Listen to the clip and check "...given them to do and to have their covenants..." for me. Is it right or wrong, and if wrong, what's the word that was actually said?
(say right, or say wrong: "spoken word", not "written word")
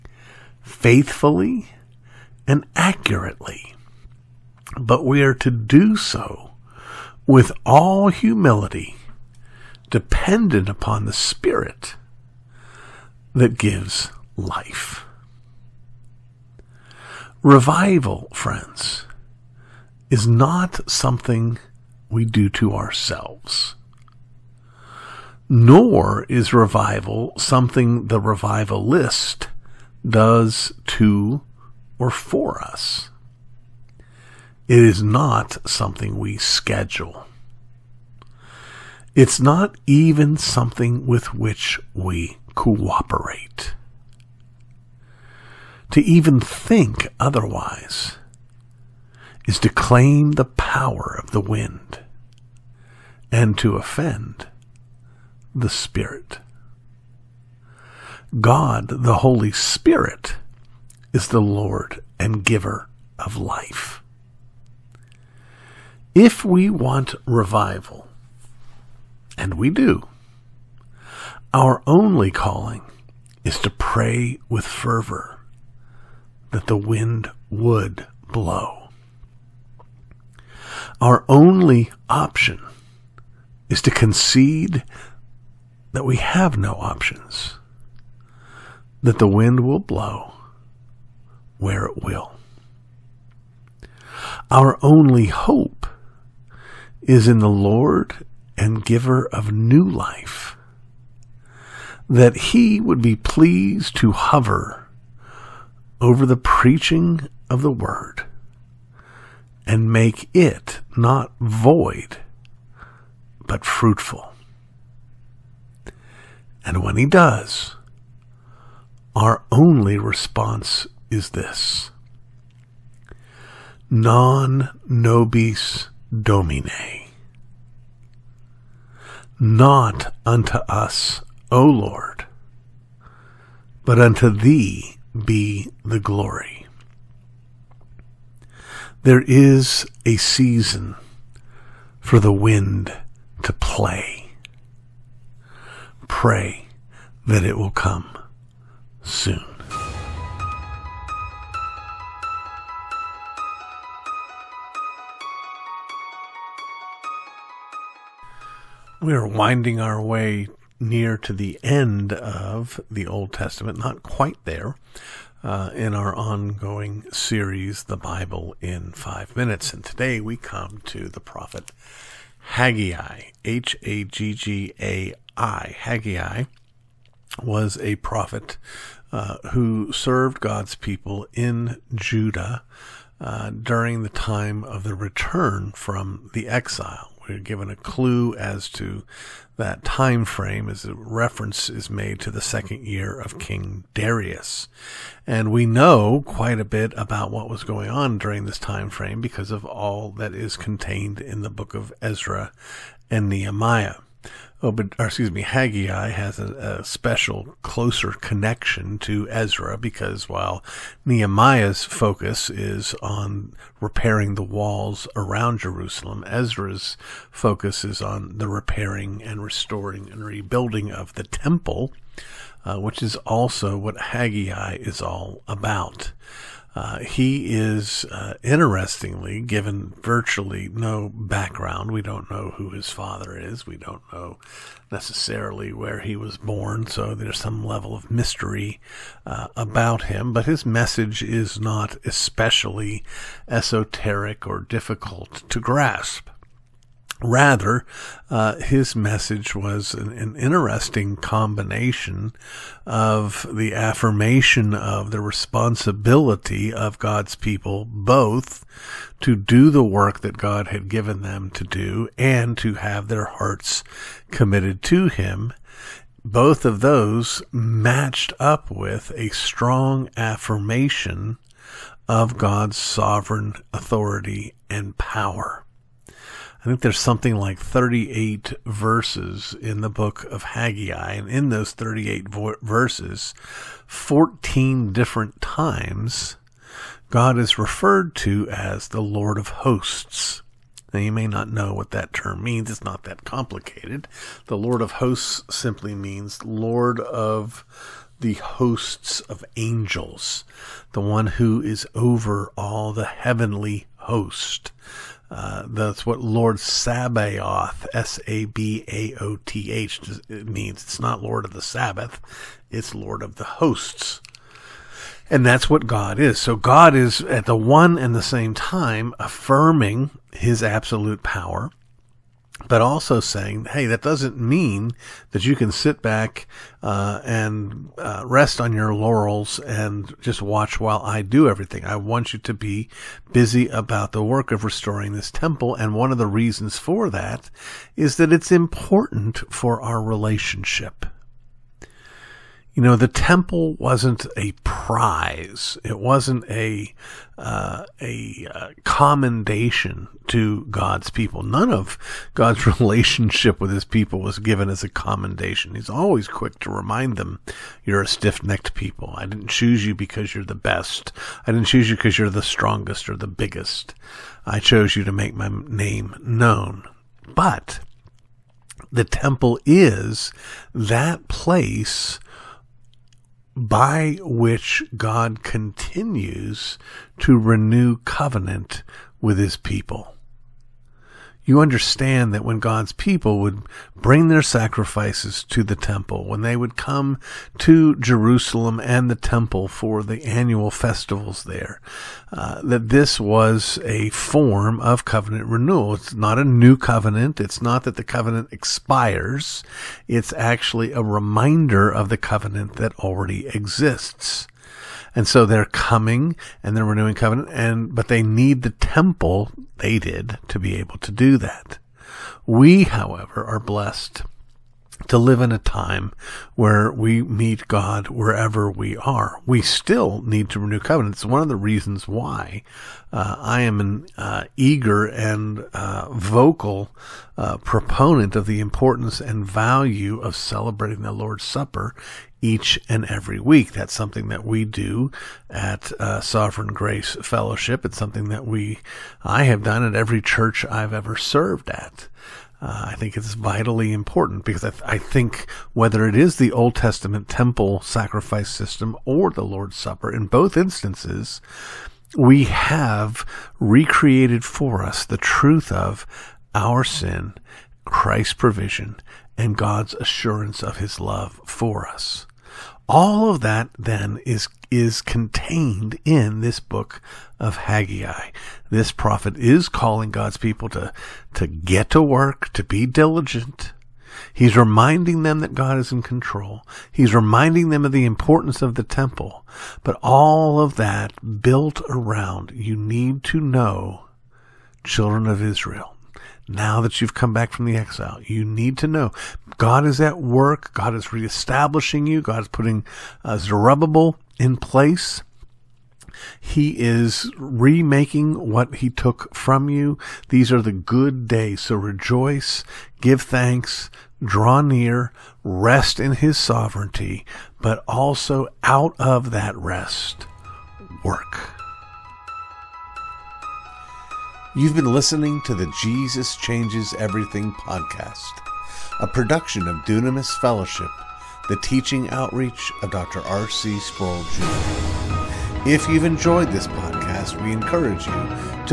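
wrong: "hearts", not "covenants".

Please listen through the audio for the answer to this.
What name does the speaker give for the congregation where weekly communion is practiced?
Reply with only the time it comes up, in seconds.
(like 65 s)
436 s.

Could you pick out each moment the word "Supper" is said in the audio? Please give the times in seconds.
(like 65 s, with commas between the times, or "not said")
431 s, 449 s.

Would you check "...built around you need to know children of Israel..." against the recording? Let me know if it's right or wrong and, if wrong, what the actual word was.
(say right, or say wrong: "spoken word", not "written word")
right.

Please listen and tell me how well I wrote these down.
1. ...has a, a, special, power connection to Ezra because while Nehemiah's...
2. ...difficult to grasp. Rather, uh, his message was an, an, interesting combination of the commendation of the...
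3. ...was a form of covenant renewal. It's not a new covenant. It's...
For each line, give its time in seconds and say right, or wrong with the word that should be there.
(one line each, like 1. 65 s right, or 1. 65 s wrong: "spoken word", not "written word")
1. 206 s wrong: "closer", not "power"
2. 244 s wrong: "affirmation", not "commendation"
3. 393 s right.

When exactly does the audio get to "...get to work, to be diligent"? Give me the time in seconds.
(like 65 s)
471 s.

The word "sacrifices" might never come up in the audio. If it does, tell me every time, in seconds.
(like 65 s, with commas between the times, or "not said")
384 s, 447 s.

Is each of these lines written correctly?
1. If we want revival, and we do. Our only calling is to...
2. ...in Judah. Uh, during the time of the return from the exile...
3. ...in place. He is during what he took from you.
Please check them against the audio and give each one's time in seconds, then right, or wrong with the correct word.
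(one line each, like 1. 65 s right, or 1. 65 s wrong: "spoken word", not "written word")
1. 66 s right
2. 181 s right
3. 494 s wrong: "remaking", not "during".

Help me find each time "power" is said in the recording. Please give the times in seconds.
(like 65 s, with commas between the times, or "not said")
50 s, 274 s, 321 s.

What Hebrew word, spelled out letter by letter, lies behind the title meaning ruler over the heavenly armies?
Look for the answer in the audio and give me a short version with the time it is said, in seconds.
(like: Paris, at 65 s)
Sabaoth, at 306 s.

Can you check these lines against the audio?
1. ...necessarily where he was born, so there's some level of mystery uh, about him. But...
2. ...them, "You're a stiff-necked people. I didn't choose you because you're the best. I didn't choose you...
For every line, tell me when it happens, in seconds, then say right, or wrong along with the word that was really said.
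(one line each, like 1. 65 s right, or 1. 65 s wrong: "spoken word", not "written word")
1. 234 s right
2. 357 s right.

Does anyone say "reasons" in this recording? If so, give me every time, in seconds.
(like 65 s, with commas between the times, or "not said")
336 s, 421 s.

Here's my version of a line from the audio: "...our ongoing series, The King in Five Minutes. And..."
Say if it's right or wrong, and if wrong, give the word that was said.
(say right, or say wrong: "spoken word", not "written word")
wrong: "Bible", not "King".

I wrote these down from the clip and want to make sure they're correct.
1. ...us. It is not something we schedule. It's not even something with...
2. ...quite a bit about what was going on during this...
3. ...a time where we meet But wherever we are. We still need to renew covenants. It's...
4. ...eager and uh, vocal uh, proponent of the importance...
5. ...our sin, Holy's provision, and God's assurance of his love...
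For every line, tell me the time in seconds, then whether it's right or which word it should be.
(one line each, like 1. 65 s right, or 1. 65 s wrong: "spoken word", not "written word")
1. 32 s right
2. 196 s right
3. 415 s wrong: "God", not "But"
4. 424 s right
5. 456 s wrong: "Christ", not "Holy".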